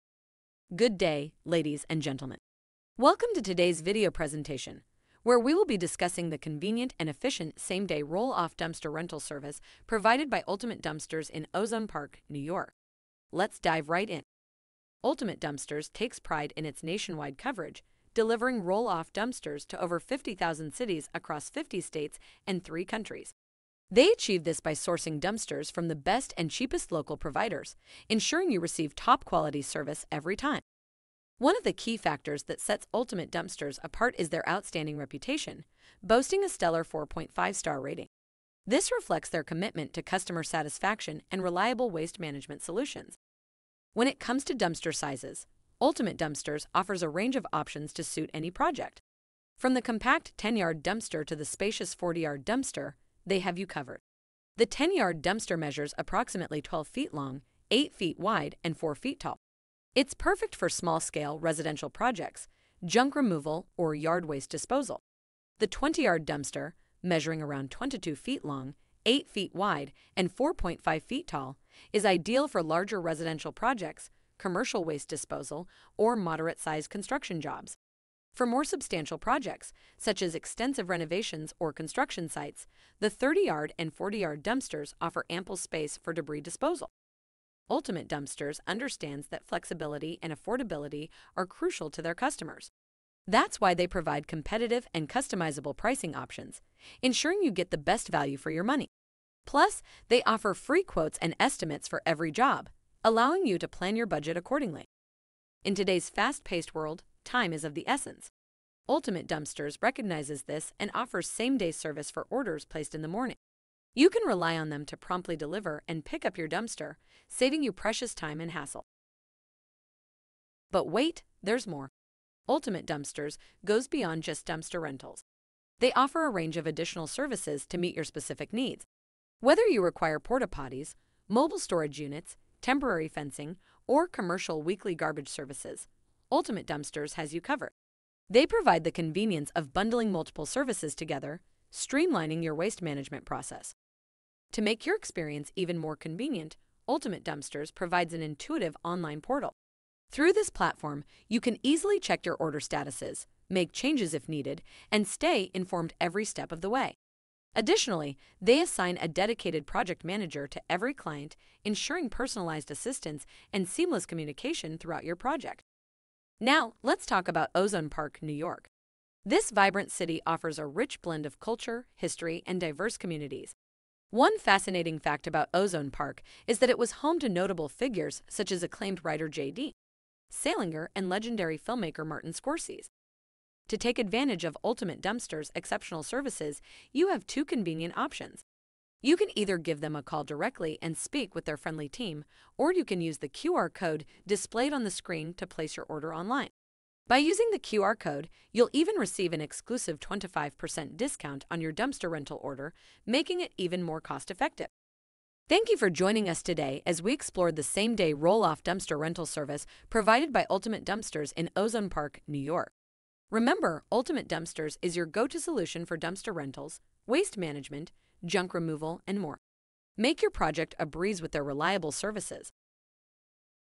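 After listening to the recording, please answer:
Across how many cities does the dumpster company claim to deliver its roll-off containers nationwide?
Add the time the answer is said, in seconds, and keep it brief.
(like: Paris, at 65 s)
50,000, at 19 s.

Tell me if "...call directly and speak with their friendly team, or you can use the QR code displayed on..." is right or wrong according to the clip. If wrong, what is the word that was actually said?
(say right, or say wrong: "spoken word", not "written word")
right.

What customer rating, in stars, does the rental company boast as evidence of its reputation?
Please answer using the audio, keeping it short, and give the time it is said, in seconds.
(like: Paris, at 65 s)
4.5 star, at 36 s.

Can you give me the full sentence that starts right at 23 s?
They achieve this by sourcing dumpsters from the best and cheapest local providers, ensuring you receive top quality service every time.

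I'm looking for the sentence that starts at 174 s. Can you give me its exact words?
One fascinating fact about Ozone Park is that it was home to notable figures such as acclaimed writer J.D.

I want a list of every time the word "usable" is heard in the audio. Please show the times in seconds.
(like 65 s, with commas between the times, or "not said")
not said.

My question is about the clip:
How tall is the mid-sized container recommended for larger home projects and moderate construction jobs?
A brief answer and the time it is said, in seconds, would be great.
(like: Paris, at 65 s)
4.5 feet, at 70 s.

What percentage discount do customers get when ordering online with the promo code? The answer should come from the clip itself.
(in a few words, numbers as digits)
25%.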